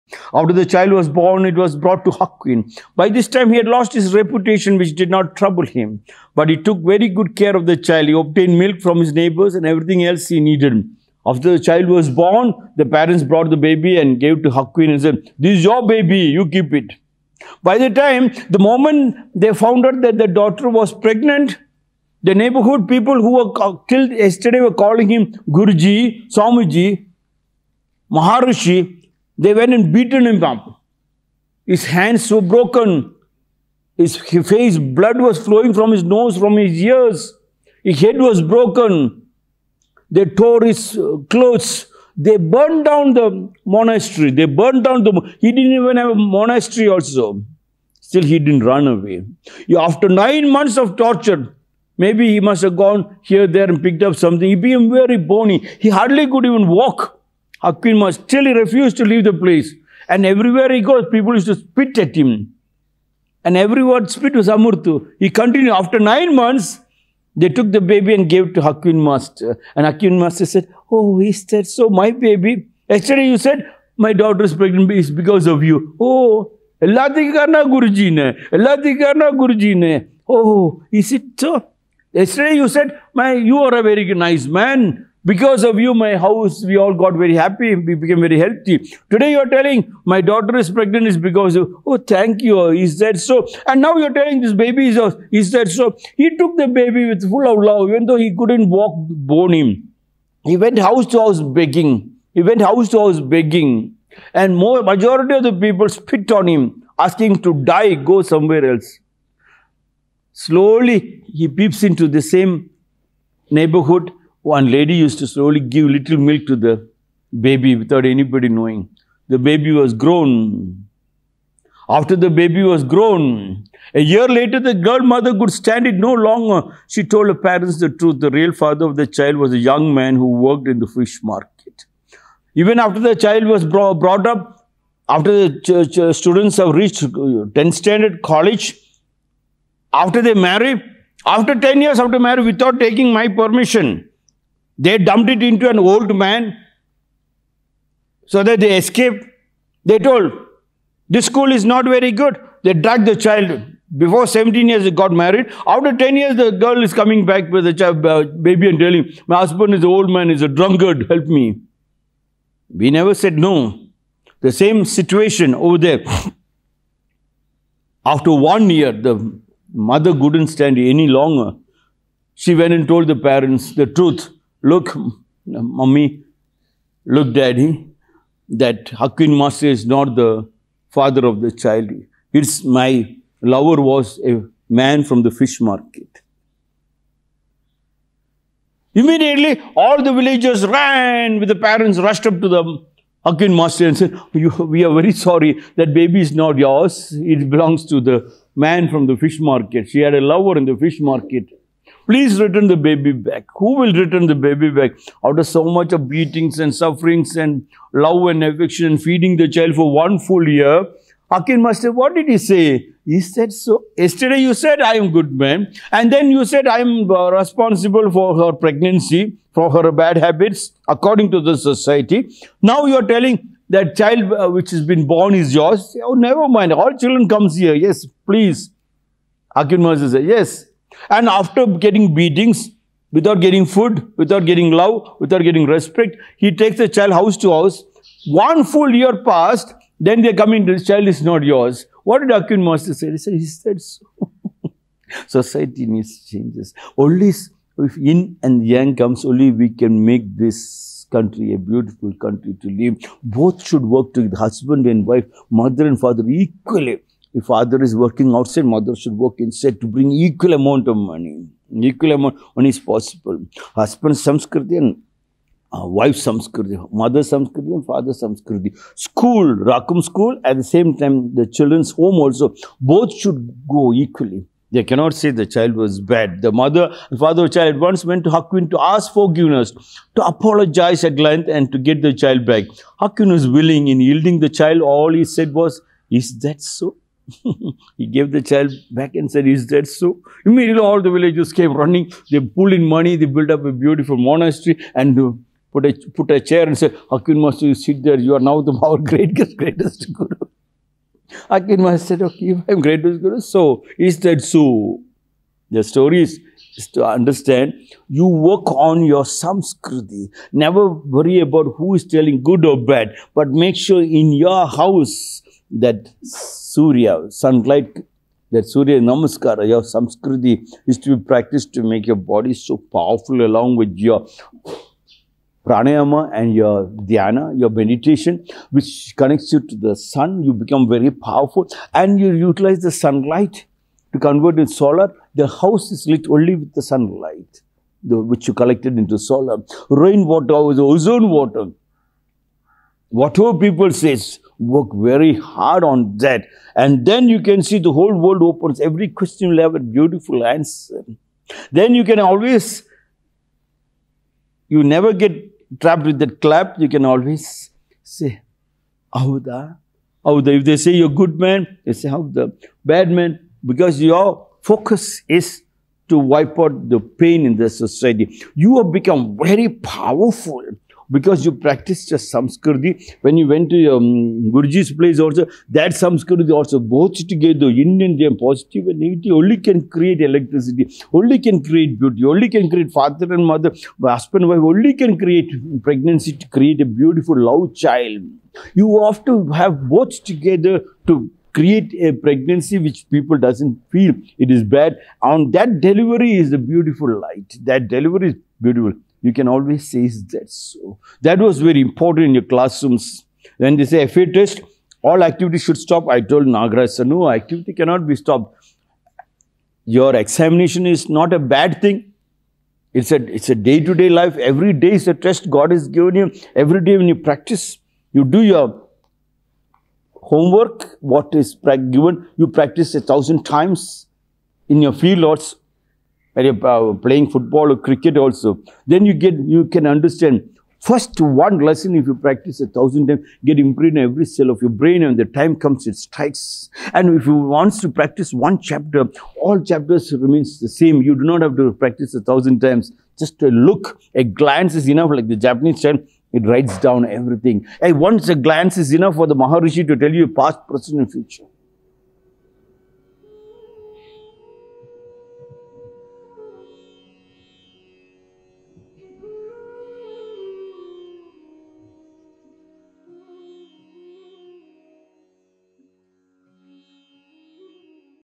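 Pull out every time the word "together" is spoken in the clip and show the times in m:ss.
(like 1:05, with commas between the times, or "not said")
4:14, 6:17, 6:30.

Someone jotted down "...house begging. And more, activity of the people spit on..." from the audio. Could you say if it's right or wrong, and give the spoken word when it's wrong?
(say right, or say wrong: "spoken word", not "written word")
wrong: "majority", not "activity".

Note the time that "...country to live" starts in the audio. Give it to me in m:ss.
4:12.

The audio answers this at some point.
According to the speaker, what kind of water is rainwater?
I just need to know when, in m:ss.
5:40.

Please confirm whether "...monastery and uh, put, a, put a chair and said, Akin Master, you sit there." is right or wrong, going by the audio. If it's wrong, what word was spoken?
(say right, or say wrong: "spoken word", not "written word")
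right.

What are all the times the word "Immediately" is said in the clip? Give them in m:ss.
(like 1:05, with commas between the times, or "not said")
3:08, 4:50.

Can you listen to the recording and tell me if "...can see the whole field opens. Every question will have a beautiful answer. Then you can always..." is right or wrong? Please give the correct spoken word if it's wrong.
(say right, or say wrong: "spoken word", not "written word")
wrong: "world", not "field".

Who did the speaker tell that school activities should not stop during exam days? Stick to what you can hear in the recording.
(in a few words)
Nagaraj.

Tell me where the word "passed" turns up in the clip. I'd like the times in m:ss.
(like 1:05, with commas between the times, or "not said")
3:59.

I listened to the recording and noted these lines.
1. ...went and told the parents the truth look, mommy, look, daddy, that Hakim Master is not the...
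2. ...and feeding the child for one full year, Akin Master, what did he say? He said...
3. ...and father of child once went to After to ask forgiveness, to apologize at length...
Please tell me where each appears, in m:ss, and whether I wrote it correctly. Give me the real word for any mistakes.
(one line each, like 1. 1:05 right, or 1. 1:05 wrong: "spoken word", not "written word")
1. 2:52 right
2. 3:28 right
3. 4:37 wrong: "Hakuin", not "After".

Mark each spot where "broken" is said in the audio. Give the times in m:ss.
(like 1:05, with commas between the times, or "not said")
0:32, 0:38.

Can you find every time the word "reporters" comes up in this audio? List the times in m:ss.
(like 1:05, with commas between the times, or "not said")
not said.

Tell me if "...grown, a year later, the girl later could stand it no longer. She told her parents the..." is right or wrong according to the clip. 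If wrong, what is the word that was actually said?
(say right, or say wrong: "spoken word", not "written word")
wrong: "mother", not "later".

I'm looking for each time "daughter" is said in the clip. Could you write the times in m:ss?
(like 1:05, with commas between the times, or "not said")
0:20, 1:14, 1:30.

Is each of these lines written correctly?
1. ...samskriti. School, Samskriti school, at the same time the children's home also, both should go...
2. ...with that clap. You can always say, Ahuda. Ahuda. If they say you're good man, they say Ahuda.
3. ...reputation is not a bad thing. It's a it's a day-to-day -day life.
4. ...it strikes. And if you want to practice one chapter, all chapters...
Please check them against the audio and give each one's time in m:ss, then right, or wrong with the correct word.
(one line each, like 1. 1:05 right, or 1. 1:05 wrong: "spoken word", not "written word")
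1. 4:28 wrong: "Rakum", not "Samskriti"
2. 5:56 right
3. 6:50 wrong: "examination", not "reputation"
4. 7:15 right.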